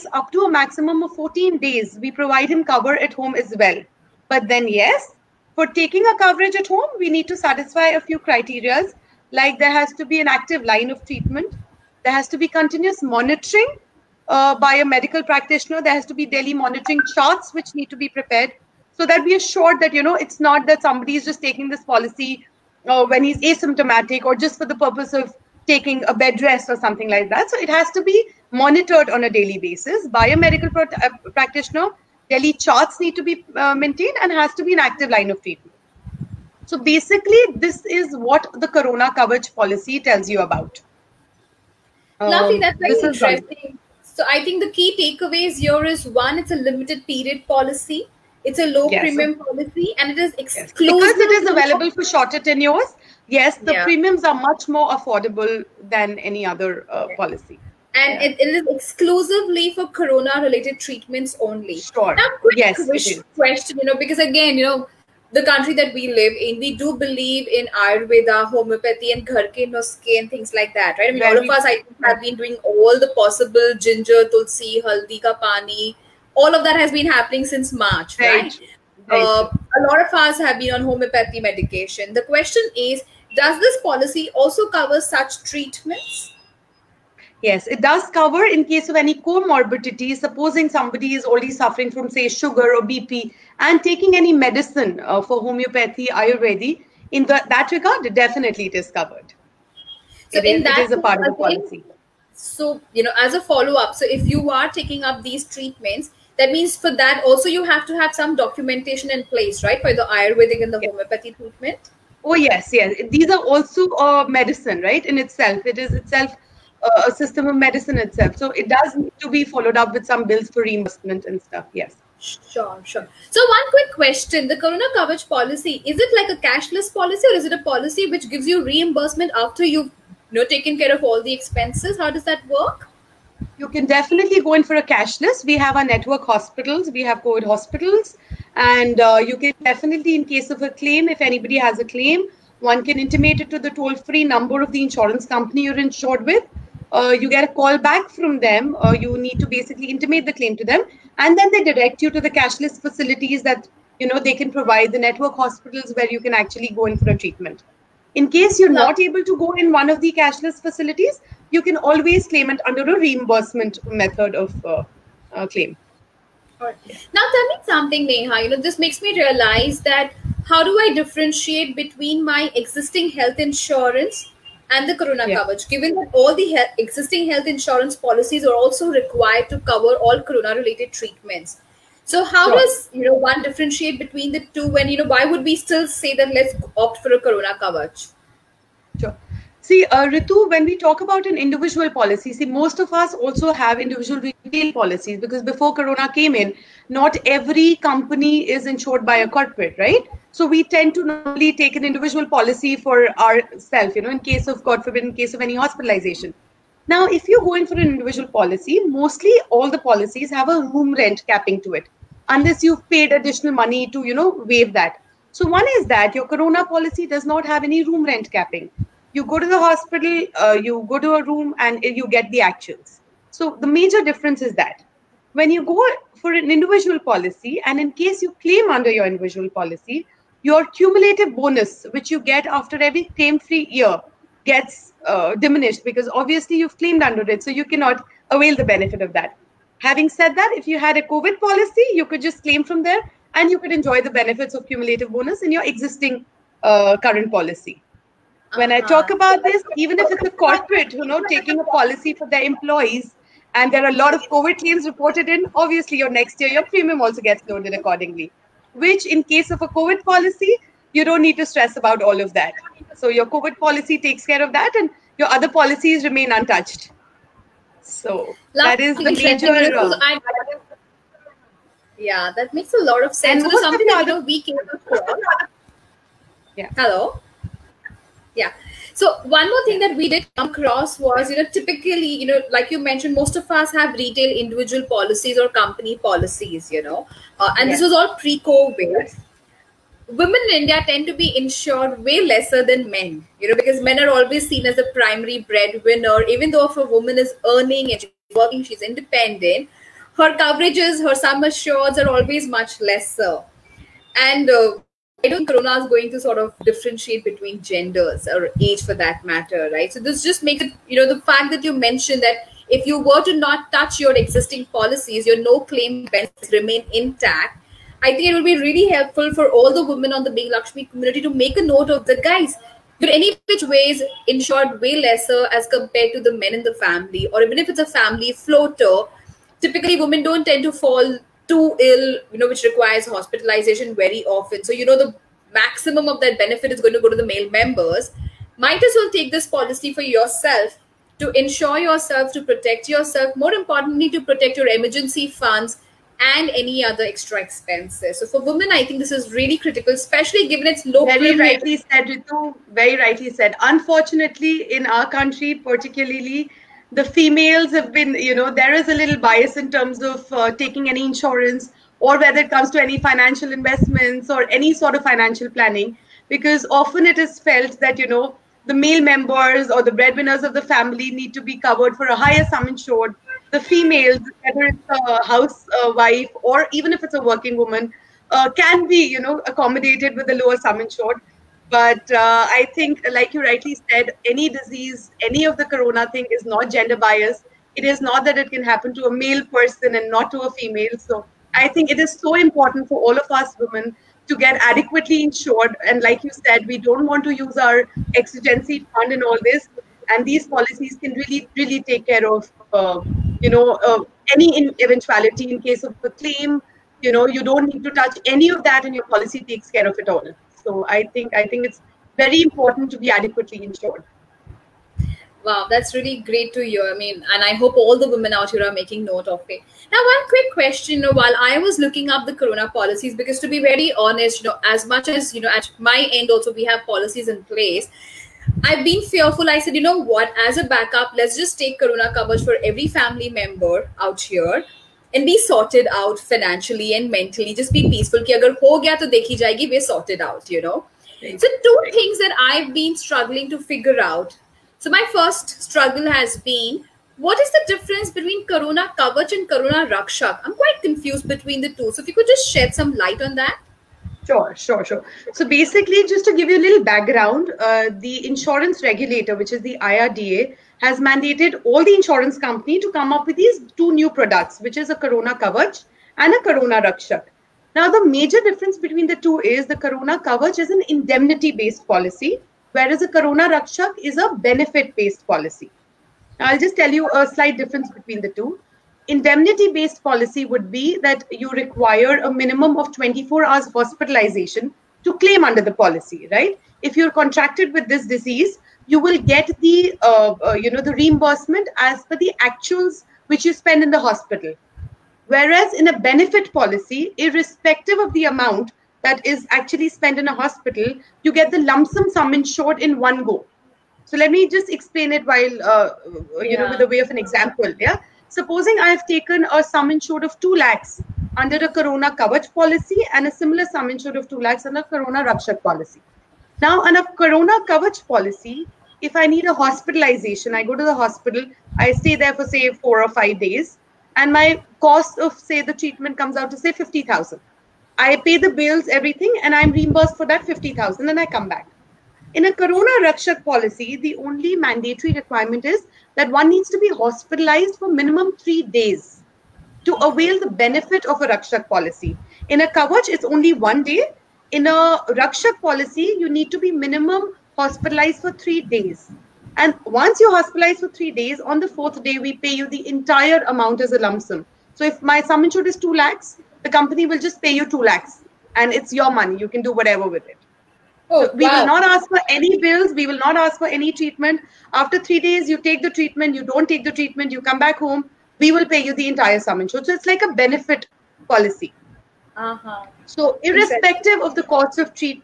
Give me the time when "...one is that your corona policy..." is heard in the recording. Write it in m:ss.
3:35.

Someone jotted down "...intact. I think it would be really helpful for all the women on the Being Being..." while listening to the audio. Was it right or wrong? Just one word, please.
wrong.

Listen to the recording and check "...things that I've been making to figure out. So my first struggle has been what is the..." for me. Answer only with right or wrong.
wrong.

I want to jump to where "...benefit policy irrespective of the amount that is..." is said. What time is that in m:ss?
8:15.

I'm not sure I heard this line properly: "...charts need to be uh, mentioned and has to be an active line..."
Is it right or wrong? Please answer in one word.
wrong.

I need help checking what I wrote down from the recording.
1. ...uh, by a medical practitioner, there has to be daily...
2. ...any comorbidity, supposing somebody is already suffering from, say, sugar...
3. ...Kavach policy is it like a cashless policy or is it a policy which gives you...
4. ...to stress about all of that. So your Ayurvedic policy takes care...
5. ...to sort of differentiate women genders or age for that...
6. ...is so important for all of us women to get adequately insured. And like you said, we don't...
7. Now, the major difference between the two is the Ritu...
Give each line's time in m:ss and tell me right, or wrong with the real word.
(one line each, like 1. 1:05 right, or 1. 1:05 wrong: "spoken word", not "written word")
1. 0:14 right
2. 1:28 right
3. 2:04 right
4. 4:21 wrong: "COVID", not "Ayurvedic"
5. 5:06 wrong: "between", not "women"
6. 6:31 right
7. 7:47 wrong: "Corona", not "Ritu".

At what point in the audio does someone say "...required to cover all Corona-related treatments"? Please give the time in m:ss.
2:58.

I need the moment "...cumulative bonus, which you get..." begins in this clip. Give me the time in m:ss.
3:50.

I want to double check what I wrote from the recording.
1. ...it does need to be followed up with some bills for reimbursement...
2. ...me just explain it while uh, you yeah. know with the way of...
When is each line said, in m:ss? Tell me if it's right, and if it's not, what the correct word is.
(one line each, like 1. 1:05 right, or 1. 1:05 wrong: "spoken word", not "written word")
1. 1:58 right
2. 8:24 right.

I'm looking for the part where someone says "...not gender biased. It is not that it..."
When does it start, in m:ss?
6:26.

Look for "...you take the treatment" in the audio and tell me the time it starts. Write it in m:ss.
9:25.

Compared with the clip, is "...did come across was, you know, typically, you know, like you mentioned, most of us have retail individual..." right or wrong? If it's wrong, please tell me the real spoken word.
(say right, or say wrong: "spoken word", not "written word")
right.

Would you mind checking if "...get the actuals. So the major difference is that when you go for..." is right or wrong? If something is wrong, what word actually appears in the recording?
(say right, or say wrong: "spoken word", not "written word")
right.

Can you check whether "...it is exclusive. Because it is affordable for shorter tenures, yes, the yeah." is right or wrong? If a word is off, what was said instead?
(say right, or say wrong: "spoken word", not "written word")
wrong: "available", not "affordable".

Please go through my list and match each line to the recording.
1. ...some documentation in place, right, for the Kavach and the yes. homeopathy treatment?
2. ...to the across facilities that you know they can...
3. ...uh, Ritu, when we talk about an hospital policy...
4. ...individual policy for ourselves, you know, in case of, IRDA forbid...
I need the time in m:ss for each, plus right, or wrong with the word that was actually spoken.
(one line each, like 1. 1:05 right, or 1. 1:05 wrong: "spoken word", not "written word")
1. 1:48 wrong: "Ayurvedic", not "Kavach"
2. 2:32 wrong: "cashless", not "across"
3. 3:09 wrong: "individual", not "hospital"
4. 3:21 wrong: "God", not "IRDA".